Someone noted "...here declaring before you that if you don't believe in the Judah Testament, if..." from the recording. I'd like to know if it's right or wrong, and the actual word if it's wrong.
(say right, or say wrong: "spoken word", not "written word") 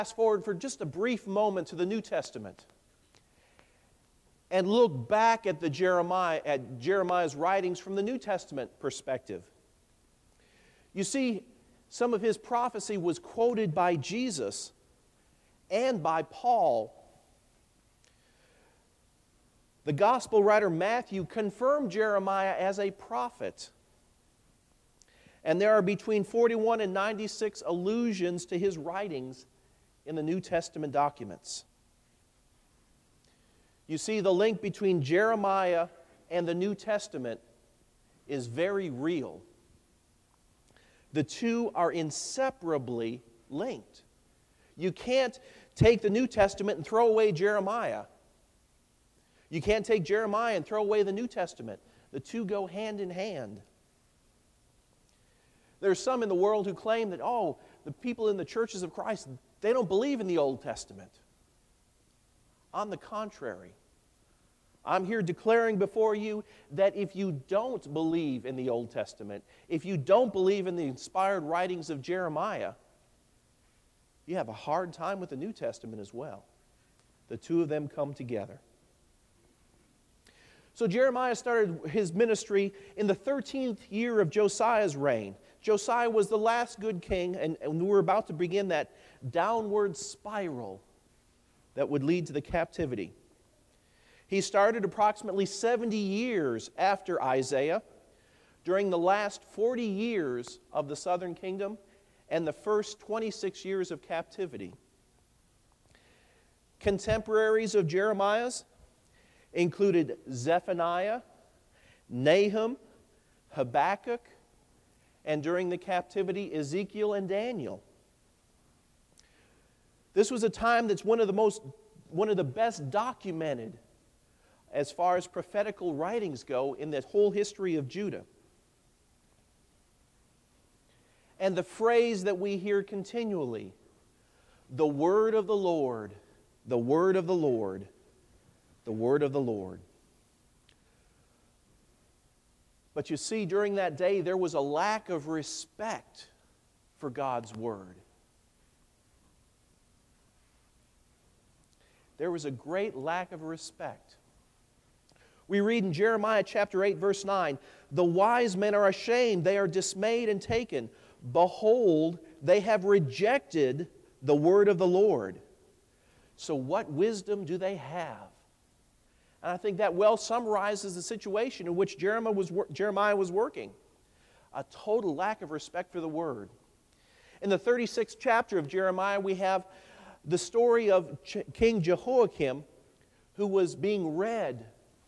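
wrong: "Old", not "Judah".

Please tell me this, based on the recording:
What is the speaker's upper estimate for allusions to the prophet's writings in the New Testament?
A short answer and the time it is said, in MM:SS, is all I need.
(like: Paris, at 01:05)
96, at 00:26.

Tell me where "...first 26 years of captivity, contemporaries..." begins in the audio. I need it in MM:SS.
01:42.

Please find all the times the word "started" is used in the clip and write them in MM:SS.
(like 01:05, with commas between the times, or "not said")
01:21, 01:34.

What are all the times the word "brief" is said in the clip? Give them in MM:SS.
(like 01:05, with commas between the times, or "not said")
00:00.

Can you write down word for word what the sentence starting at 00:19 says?
The gospel writer Matthew confirmed Jeremiah as a prophet.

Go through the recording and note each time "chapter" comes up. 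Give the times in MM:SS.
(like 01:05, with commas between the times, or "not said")
02:36, 02:58.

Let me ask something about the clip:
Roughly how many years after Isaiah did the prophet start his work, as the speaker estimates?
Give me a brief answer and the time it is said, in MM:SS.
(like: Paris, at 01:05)
70, at 01:35.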